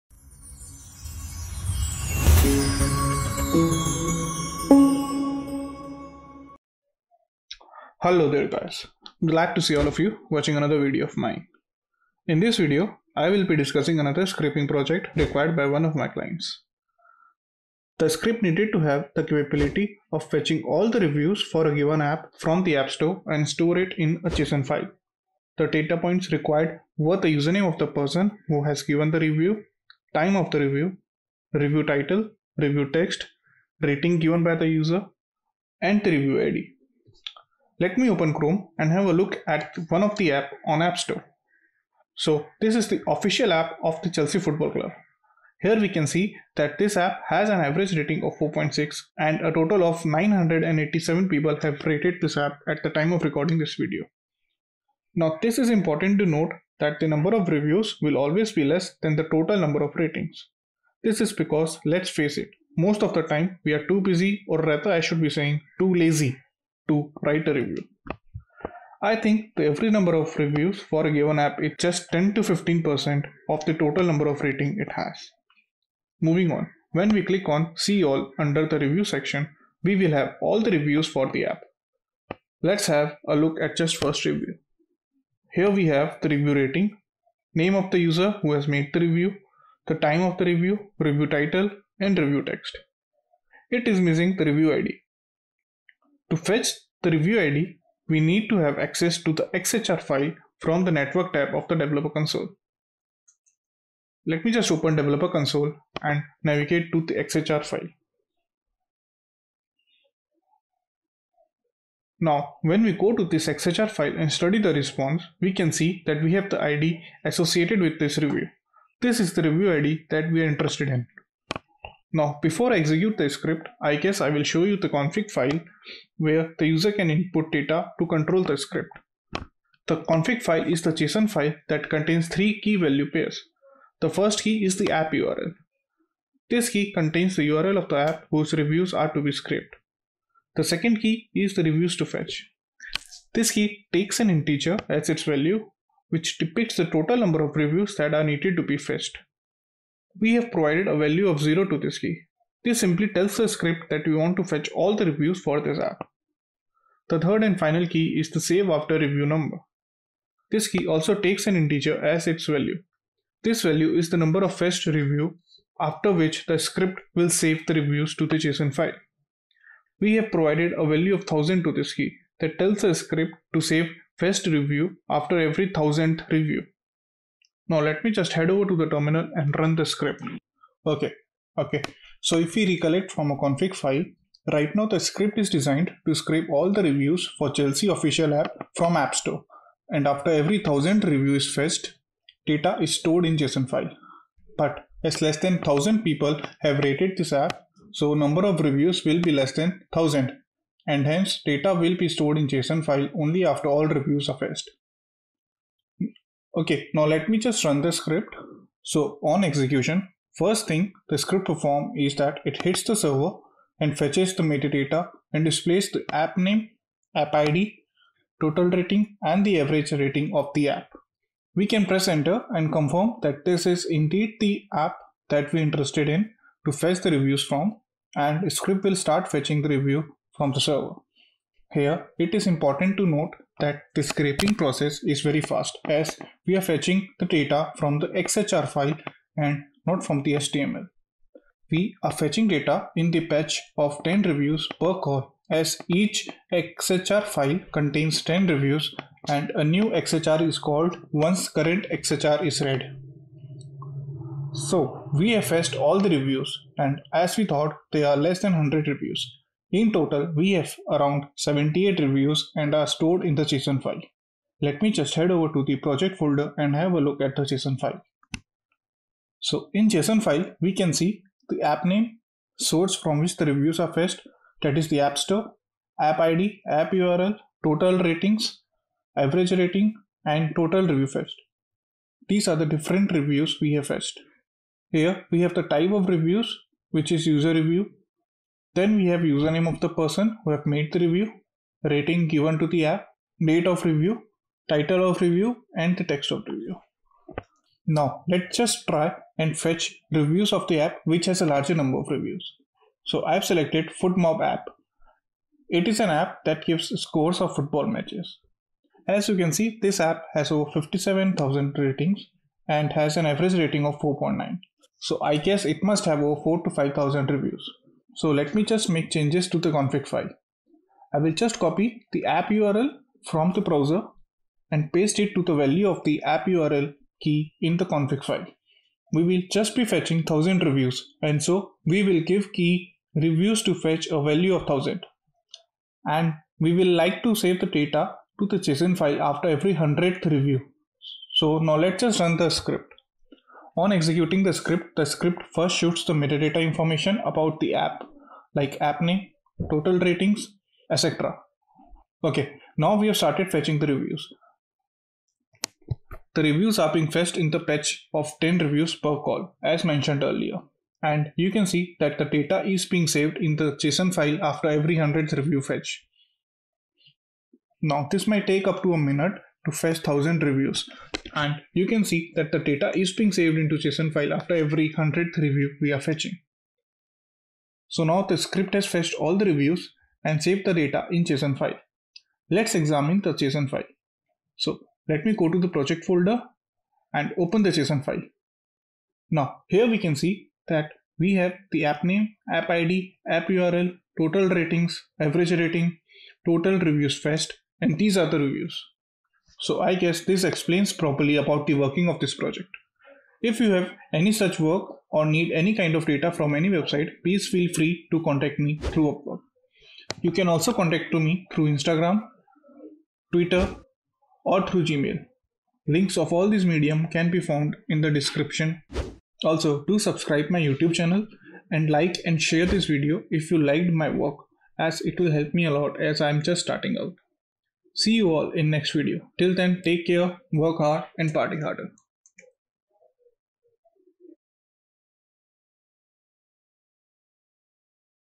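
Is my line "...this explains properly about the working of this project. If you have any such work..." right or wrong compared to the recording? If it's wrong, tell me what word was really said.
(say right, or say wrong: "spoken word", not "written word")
right.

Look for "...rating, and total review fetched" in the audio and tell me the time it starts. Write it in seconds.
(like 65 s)
279 s.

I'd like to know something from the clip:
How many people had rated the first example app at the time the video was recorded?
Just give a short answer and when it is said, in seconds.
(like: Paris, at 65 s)
987, at 50 s.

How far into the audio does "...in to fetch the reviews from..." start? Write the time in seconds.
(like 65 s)
226 s.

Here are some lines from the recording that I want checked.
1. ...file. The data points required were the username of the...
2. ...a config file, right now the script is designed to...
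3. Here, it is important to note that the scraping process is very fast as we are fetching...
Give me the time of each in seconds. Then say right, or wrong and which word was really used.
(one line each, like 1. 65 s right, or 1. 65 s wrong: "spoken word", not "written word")
1. 24 s right
2. 183 s right
3. 231 s right.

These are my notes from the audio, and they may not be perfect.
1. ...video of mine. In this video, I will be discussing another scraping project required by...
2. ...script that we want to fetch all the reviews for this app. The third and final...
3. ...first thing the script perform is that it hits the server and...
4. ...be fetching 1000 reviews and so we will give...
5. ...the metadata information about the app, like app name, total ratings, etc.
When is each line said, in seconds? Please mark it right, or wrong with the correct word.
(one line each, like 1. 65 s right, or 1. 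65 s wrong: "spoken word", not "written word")
1. 10 s right
2. 153 s right
3. 210 s right
4. 329 s right
5. 346 s right.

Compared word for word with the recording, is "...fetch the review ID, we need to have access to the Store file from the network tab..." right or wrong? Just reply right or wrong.
wrong.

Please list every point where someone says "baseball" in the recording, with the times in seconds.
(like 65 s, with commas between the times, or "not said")
not said.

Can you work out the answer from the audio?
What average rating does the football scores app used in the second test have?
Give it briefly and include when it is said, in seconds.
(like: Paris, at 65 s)
4.9, at 313 s.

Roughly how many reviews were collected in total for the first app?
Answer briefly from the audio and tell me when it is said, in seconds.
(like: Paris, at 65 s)
78, at 261 s.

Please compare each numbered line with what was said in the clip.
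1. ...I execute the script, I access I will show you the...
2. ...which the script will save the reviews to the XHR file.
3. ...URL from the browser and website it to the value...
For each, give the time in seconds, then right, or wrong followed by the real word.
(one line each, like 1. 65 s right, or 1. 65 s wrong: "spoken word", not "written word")
1. 122 s wrong: "guess", not "access"
2. 166 s wrong: "JSON", not "XHR"
3. 322 s wrong: "paste", not "website".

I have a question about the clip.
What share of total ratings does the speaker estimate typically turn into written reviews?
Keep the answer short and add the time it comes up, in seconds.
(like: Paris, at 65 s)
10 to 15%, at 72 s.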